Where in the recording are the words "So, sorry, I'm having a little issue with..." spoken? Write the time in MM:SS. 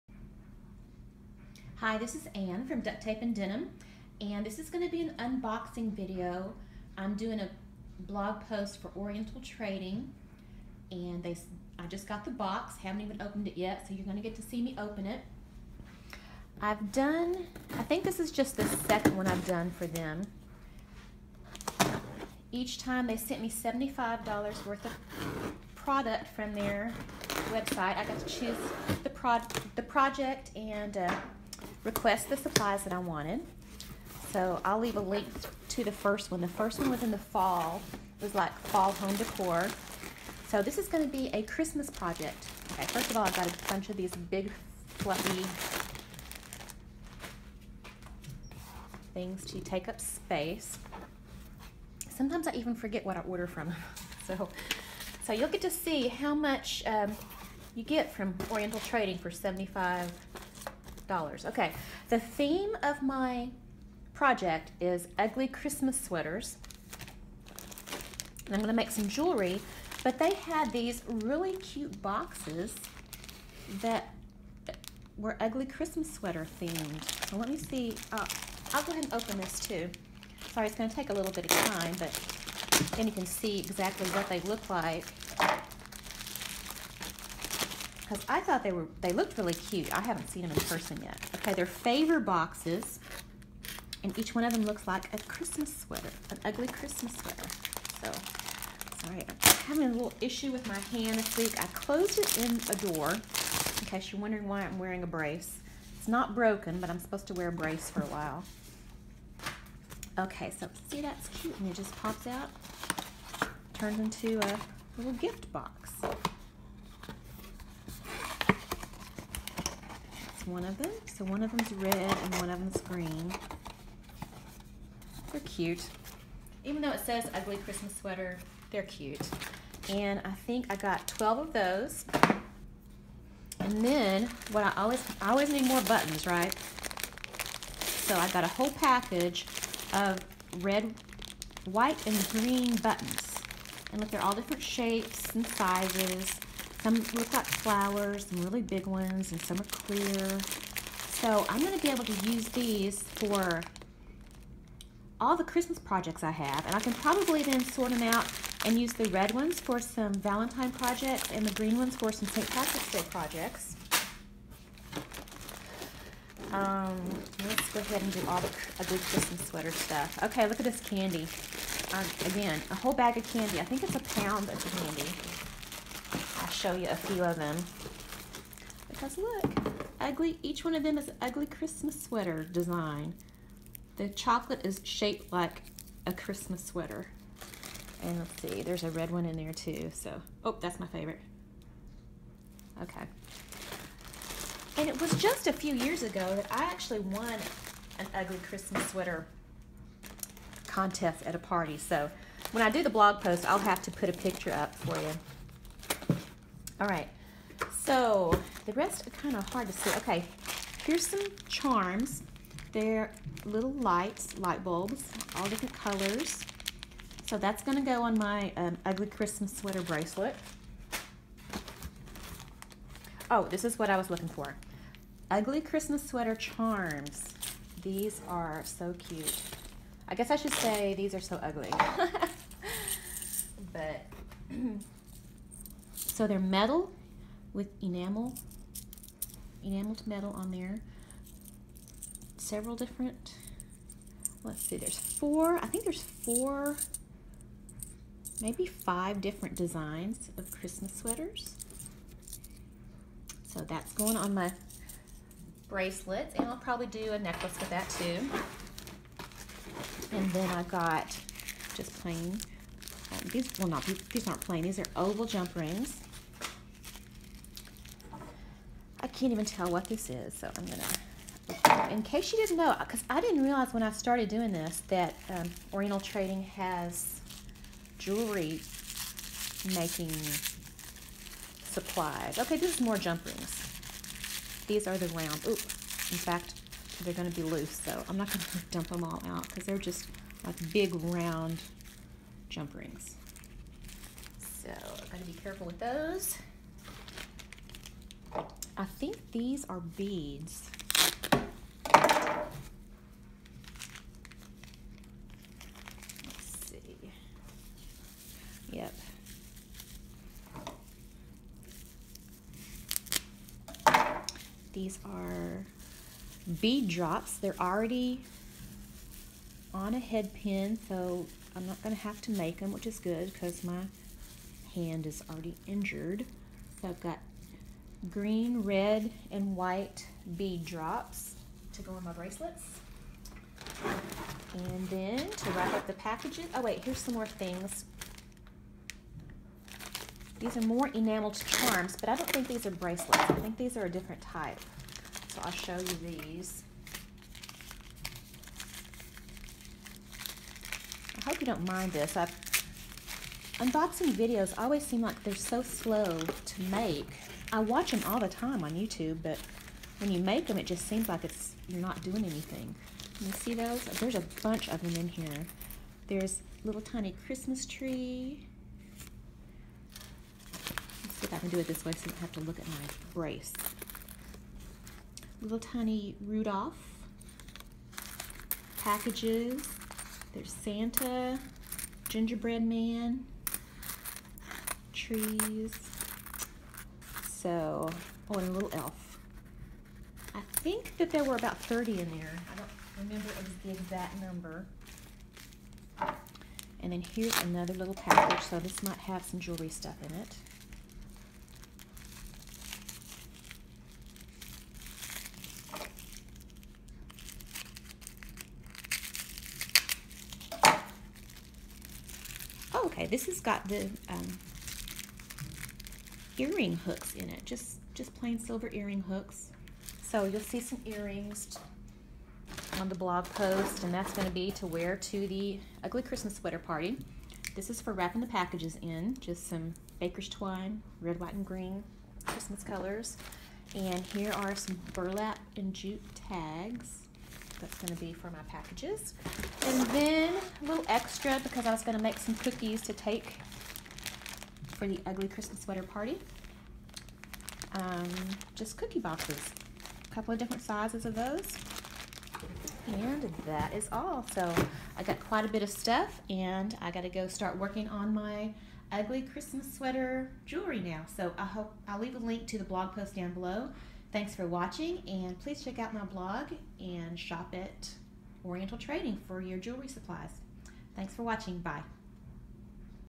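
01:38.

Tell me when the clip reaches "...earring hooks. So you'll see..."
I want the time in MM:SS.
06:58.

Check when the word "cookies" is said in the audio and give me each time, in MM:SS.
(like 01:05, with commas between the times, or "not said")
07:22, 07:28.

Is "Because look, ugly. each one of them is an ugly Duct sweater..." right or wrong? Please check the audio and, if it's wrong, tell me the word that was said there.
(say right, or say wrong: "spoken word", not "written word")
wrong: "Christmas", not "Duct".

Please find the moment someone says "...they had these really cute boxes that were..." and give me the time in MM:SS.
01:10.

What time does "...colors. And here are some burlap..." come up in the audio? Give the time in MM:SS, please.
07:12.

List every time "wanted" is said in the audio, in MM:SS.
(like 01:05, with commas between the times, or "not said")
00:32.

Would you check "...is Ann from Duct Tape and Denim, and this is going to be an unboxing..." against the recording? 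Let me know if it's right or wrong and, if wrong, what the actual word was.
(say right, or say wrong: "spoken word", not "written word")
right.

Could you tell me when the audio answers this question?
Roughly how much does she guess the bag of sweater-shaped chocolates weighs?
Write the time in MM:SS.
02:53.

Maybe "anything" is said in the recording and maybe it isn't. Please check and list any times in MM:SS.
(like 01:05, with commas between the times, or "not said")
06:02.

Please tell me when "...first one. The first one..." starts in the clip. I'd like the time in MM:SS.
00:35.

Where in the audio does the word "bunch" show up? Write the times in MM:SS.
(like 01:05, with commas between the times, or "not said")
00:43, 06:04.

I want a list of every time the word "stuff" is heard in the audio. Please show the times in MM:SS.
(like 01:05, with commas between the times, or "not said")
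02:49, 06:39, 07:35.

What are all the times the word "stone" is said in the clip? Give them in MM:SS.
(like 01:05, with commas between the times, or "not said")
not said.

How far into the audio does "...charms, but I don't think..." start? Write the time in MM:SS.
05:41.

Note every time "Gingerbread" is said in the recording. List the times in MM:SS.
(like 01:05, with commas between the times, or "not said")
06:22.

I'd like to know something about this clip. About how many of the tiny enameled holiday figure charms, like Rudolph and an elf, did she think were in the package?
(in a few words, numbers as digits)
30.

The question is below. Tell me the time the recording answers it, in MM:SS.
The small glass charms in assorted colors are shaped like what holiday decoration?
03:34.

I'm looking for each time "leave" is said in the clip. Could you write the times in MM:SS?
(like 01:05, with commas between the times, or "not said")
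00:34, 07:41.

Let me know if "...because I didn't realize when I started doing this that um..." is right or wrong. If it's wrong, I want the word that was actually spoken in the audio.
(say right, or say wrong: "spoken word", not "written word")
right.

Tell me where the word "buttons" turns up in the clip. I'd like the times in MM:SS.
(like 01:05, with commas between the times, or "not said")
02:15, 02:22.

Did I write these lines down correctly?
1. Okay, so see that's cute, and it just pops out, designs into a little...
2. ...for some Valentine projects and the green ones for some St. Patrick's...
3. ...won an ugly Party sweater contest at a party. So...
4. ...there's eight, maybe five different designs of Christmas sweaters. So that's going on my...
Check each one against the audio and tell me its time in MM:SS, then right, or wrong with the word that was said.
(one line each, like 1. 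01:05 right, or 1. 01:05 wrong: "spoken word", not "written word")
1. 01:50 wrong: "turns", not "designs"
2. 02:39 right
3. 03:16 wrong: "Christmas", not "Party"
4. 04:05 wrong: "four", not "eight".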